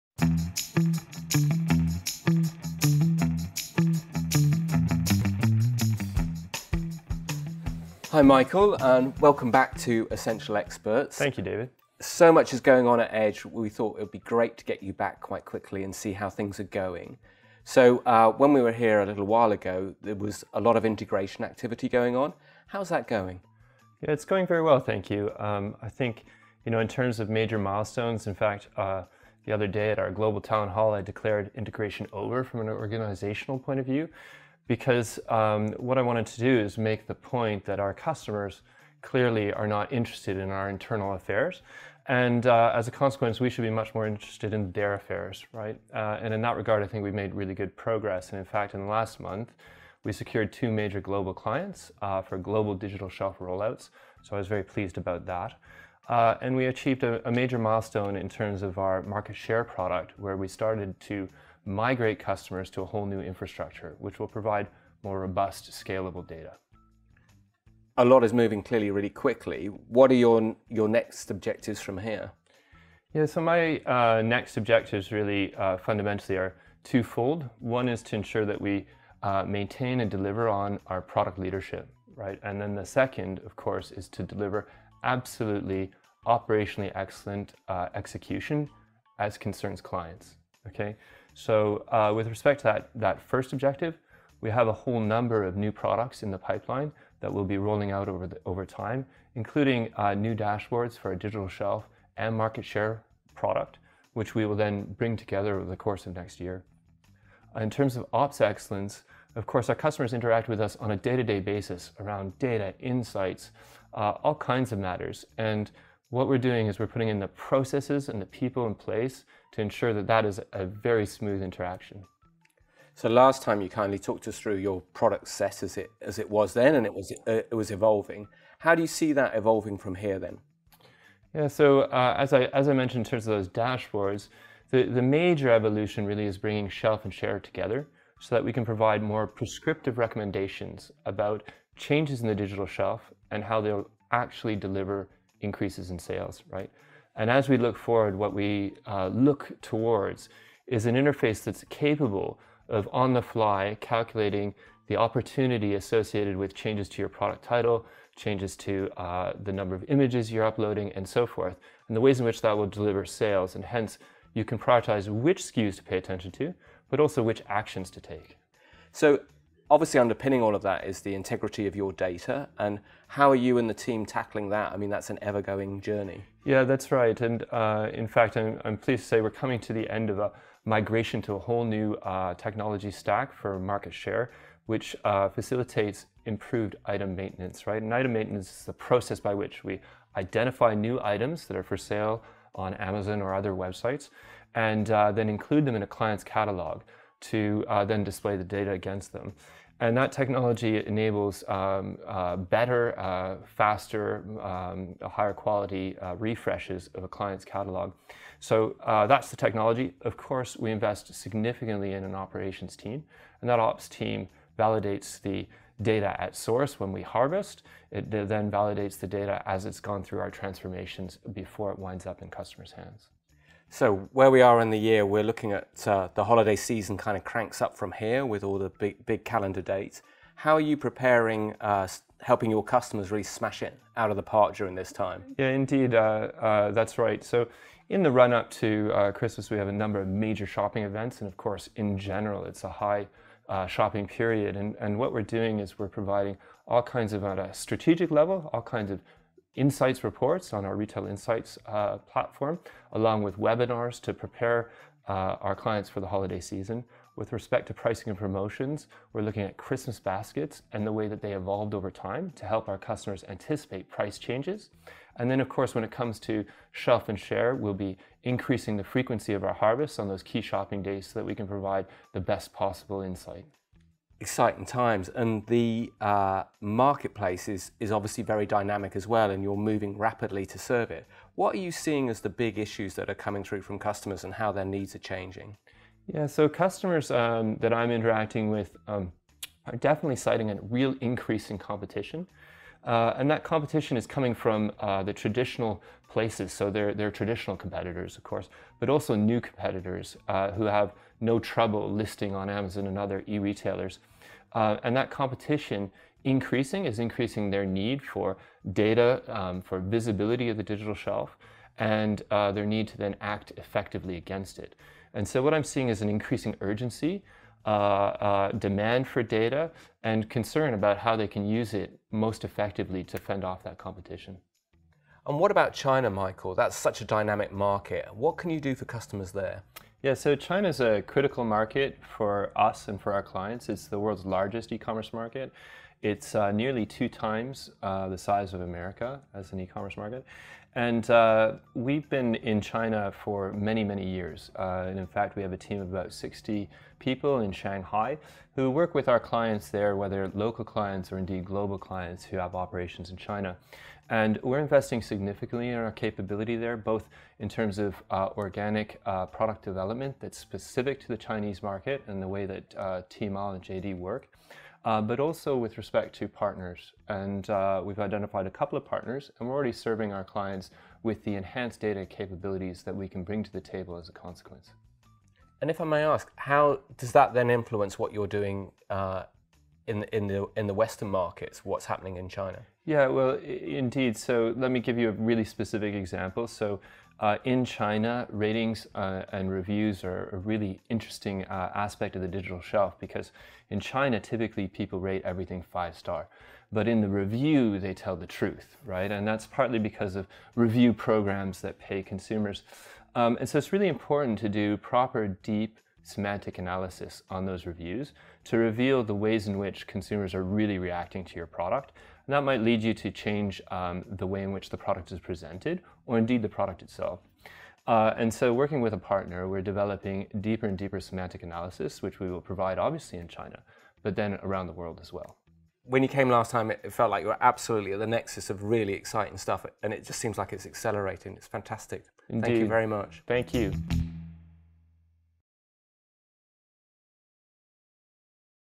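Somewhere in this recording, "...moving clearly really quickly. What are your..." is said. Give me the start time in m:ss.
1:08.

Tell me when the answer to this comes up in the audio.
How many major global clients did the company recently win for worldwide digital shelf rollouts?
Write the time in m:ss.
0:50.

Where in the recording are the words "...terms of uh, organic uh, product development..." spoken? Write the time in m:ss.
5:57.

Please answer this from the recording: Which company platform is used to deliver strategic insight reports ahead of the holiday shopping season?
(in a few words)
Retail Insights.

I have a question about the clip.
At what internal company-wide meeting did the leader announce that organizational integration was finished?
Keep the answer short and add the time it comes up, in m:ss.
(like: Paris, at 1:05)
global town hall, at 0:30.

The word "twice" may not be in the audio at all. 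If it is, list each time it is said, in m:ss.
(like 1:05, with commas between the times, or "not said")
not said.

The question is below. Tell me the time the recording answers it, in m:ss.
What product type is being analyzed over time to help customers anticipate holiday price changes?
4:19.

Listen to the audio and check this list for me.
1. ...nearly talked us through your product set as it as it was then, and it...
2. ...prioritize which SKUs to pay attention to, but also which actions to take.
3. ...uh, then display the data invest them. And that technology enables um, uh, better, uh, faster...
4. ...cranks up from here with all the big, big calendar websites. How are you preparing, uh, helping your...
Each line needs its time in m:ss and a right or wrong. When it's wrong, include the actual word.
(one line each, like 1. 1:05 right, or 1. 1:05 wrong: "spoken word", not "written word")
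1. 2:03 wrong: "kindly", not "nearly"
2. 2:44 right
3. 3:17 wrong: "against", not "invest"
4. 3:47 wrong: "dates", not "websites".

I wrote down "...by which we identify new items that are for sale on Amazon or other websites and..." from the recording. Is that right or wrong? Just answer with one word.
right.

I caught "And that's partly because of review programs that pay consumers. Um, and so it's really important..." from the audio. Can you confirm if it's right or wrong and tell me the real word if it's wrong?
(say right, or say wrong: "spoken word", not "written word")
right.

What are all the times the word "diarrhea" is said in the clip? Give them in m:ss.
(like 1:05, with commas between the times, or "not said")
not said.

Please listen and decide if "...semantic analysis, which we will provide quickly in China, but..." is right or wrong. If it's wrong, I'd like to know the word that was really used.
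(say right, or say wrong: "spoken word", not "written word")
wrong: "obviously", not "quickly".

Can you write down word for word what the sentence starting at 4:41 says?
What are you seeing as the big issues that are coming through from customers and how their needs are changing?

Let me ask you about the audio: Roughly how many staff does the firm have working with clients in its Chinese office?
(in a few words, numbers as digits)
about 60.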